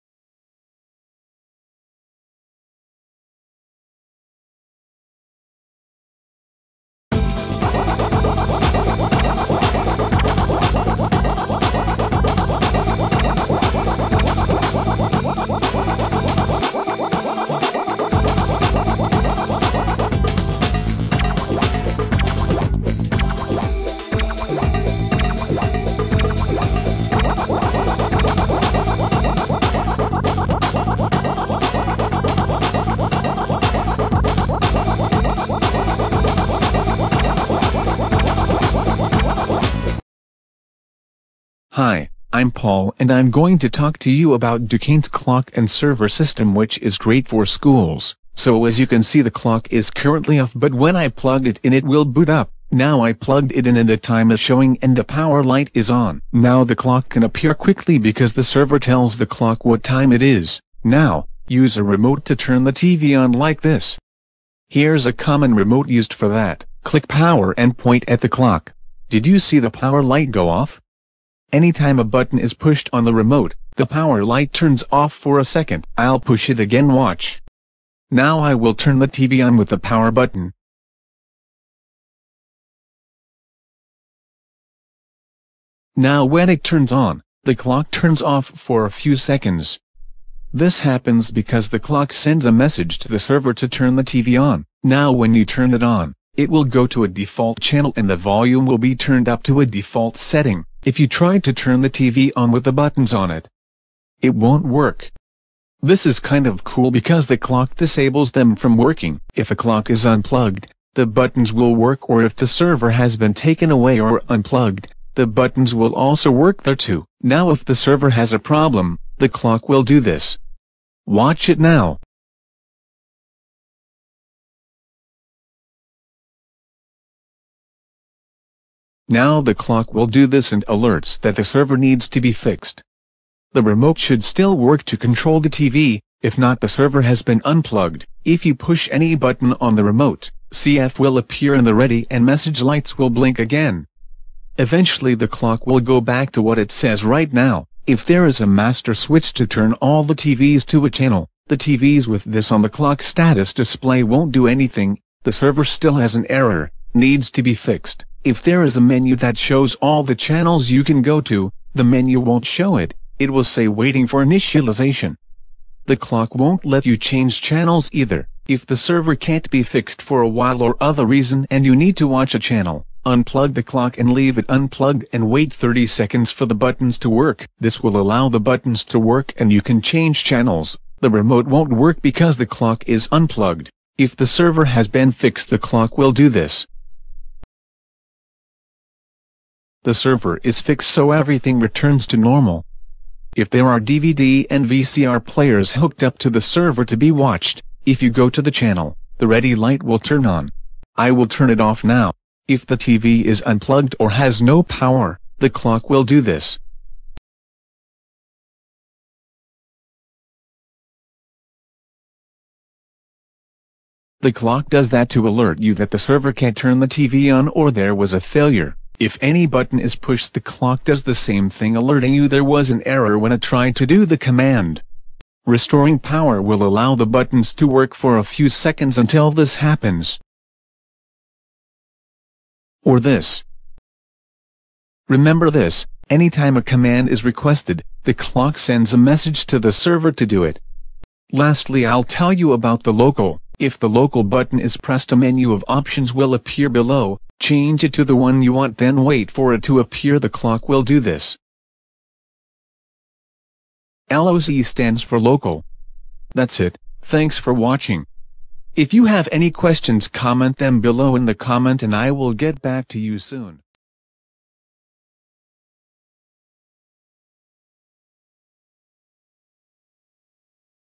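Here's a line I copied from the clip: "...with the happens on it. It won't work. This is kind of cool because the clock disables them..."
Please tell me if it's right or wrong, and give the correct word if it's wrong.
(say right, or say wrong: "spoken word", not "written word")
wrong: "buttons", not "happens".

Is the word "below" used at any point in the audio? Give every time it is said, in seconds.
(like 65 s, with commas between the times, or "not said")
246 s, 260 s.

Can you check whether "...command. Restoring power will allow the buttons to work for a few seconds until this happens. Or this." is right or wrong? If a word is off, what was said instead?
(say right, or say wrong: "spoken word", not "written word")
right.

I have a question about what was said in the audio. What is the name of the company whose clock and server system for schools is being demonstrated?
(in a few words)
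Dukane.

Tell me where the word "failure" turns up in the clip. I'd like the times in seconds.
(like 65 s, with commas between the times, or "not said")
218 s.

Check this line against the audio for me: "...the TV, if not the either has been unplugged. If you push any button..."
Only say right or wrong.
wrong.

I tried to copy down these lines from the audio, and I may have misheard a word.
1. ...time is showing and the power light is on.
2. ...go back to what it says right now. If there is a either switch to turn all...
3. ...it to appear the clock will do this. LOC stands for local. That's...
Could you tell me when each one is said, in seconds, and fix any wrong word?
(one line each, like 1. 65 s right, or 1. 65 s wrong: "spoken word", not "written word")
1. 53 s right
2. 145 s wrong: "master", not "either"
3. 249 s right.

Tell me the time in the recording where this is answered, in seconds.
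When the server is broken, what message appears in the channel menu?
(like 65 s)
163 s.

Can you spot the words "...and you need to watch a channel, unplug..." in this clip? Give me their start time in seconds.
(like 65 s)
171 s.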